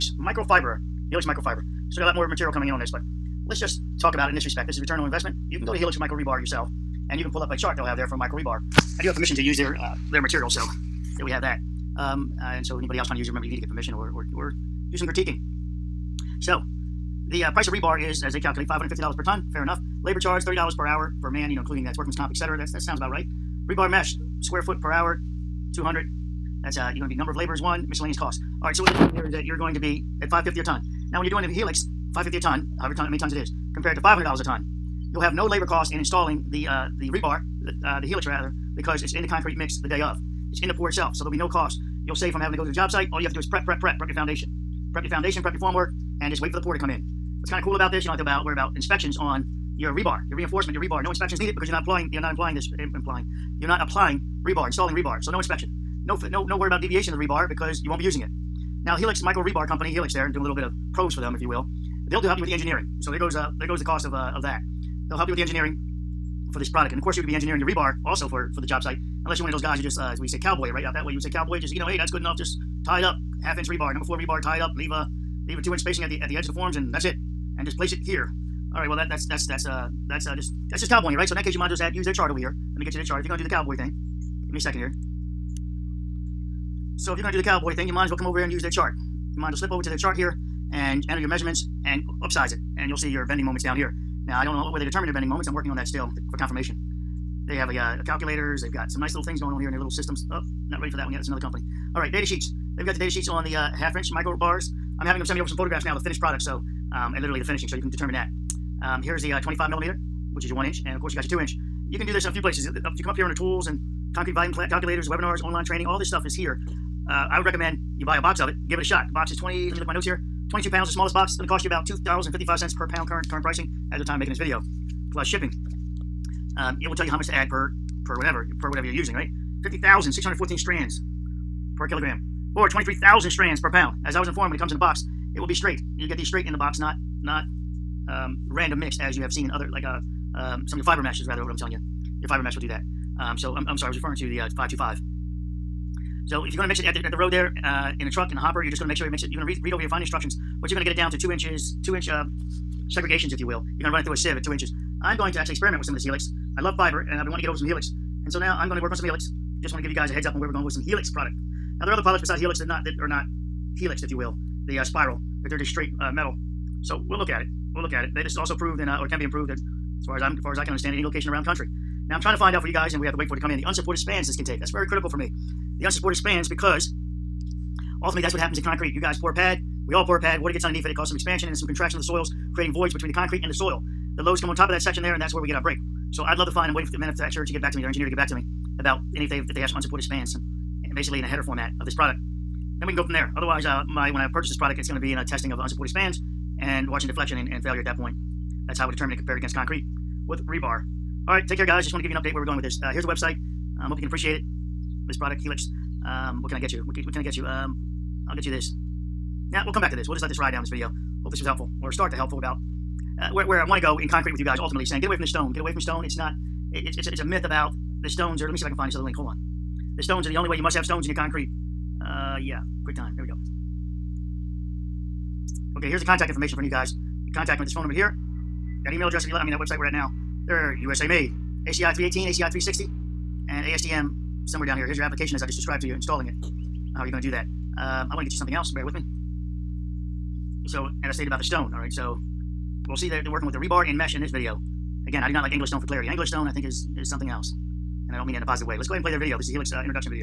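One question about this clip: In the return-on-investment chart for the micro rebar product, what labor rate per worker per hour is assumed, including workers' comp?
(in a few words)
$30.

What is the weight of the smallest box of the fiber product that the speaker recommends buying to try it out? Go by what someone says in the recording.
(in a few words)
22 pounds.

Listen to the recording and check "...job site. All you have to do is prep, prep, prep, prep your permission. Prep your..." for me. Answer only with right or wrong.
wrong.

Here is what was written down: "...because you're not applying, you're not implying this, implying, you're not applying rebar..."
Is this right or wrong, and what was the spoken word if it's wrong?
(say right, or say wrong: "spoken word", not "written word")
right.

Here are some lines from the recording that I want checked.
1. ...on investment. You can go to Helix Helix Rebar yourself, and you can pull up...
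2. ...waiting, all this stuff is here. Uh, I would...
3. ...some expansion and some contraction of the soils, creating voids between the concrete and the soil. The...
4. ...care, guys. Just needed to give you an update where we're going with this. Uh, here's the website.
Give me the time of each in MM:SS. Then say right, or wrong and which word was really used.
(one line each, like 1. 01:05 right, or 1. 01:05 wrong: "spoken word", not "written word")
1. 00:04 wrong: "Micro", not "Helix"
2. 01:55 wrong: "training", not "waiting"
3. 03:01 right
4. 03:21 wrong: "wanted", not "needed".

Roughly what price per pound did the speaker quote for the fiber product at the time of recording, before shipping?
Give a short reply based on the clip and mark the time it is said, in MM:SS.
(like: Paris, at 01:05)
$2.55, at 02:01.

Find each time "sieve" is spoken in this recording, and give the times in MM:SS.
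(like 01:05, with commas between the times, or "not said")
02:34.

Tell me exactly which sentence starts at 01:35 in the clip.
I'm working on that still to, for confirmation.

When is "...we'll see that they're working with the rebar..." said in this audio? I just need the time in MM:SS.
04:02.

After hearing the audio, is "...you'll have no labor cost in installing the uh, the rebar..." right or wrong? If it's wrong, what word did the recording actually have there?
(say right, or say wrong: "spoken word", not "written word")
right.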